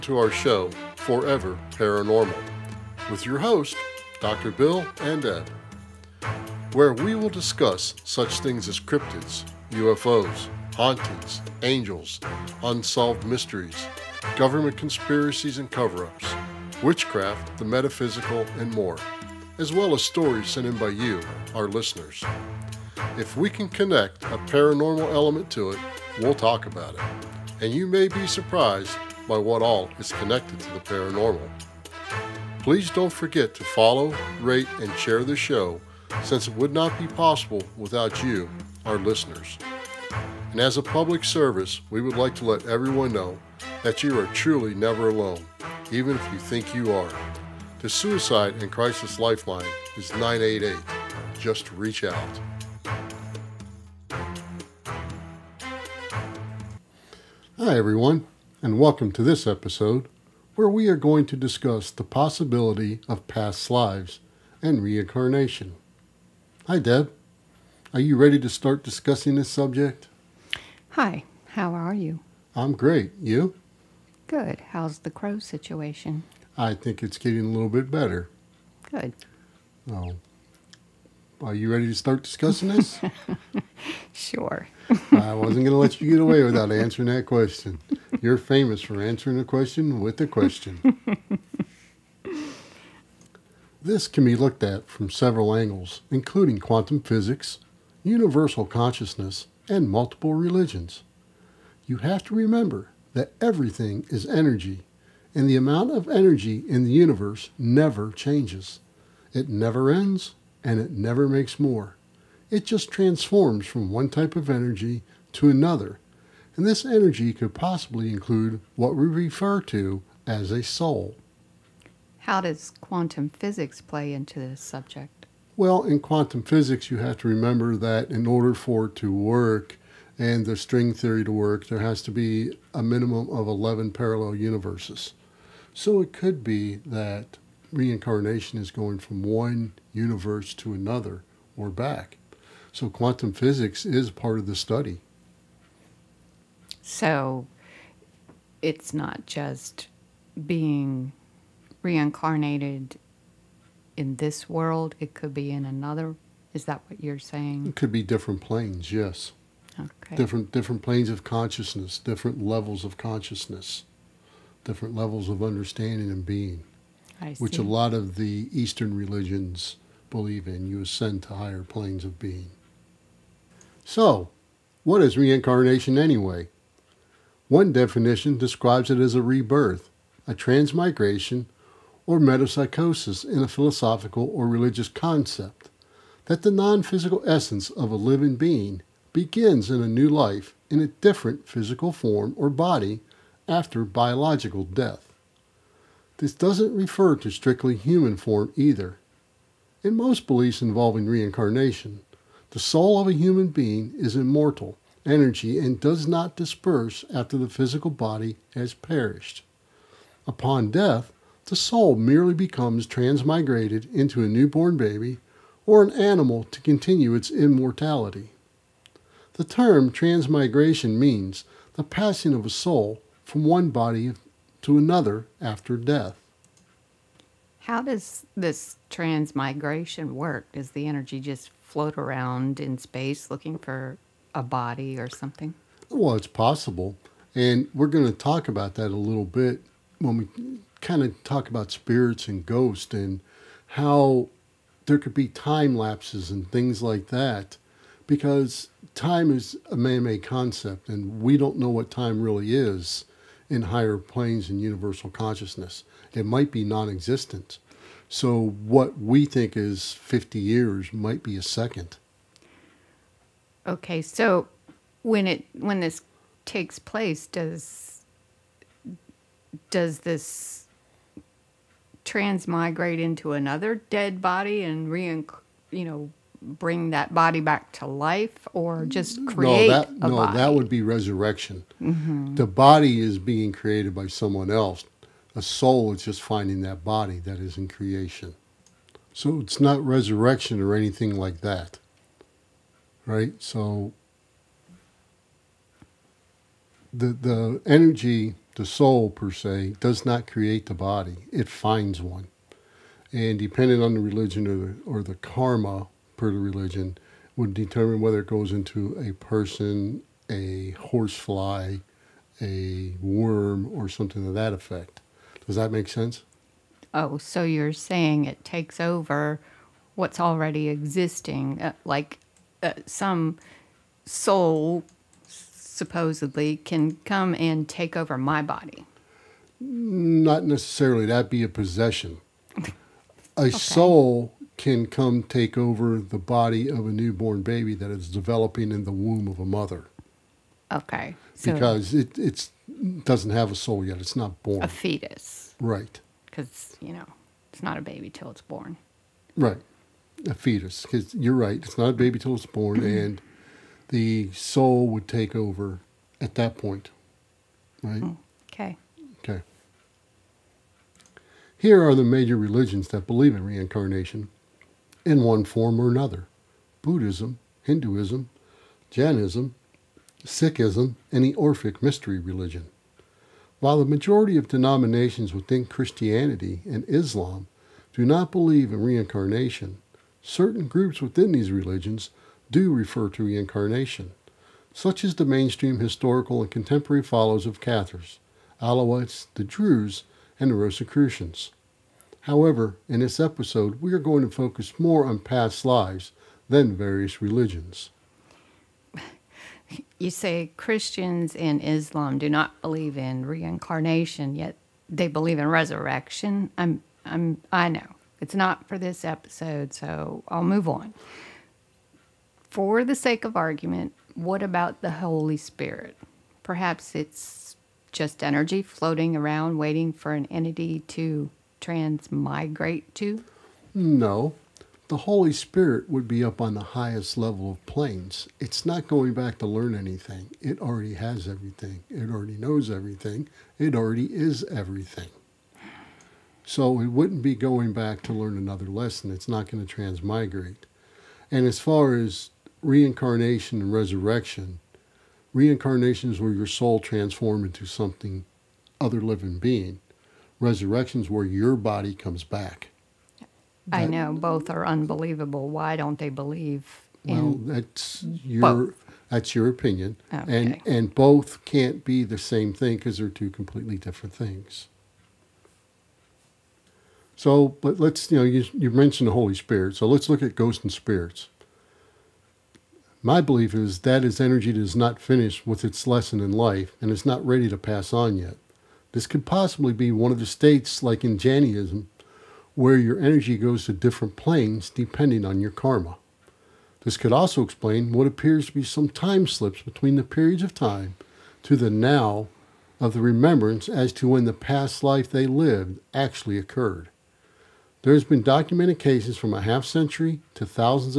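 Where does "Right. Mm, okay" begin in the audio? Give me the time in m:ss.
5:57.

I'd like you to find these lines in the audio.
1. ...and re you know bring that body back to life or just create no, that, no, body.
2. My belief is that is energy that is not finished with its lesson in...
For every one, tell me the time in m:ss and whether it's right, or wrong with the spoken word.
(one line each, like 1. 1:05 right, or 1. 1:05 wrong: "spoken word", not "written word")
1. 4:34 right
2. 7:53 right.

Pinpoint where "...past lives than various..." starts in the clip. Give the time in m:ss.
6:35.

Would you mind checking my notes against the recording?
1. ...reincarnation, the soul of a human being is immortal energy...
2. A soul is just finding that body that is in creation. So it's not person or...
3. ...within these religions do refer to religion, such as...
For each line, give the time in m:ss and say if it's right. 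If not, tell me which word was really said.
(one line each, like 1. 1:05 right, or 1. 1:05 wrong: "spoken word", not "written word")
1. 3:21 right
2. 4:45 wrong: "resurrection", not "person"
3. 6:21 wrong: "reincarnation", not "religion".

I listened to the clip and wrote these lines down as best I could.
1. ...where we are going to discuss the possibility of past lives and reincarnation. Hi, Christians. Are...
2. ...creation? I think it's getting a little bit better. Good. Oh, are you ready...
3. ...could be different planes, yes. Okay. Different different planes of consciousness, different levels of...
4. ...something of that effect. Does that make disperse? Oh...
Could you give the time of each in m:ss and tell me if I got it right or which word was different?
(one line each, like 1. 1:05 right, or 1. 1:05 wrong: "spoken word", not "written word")
1. 1:00 wrong: "Deb", not "Christians"
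2. 1:15 wrong: "situation", not "creation"
3. 2:37 right
4. 5:13 wrong: "sense", not "disperse".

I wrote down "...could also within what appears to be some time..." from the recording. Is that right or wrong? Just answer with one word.
wrong.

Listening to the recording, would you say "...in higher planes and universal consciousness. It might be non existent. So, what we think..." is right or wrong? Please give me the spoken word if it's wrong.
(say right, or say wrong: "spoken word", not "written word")
right.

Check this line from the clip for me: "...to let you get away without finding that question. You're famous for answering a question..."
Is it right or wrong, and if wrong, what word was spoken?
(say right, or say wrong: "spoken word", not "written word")
wrong: "answering", not "finding".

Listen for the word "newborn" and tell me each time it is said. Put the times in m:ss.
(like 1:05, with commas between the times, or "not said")
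3:34, 5:36.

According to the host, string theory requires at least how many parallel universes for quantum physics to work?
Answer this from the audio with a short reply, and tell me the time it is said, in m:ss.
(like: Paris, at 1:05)
11, at 2:13.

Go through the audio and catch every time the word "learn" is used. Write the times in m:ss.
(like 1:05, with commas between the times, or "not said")
7:09, 7:18.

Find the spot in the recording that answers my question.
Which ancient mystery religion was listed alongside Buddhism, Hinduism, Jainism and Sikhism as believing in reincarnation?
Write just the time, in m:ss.
6:11.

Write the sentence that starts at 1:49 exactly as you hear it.
It never ends and it never makes more.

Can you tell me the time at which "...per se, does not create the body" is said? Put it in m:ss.
4:59.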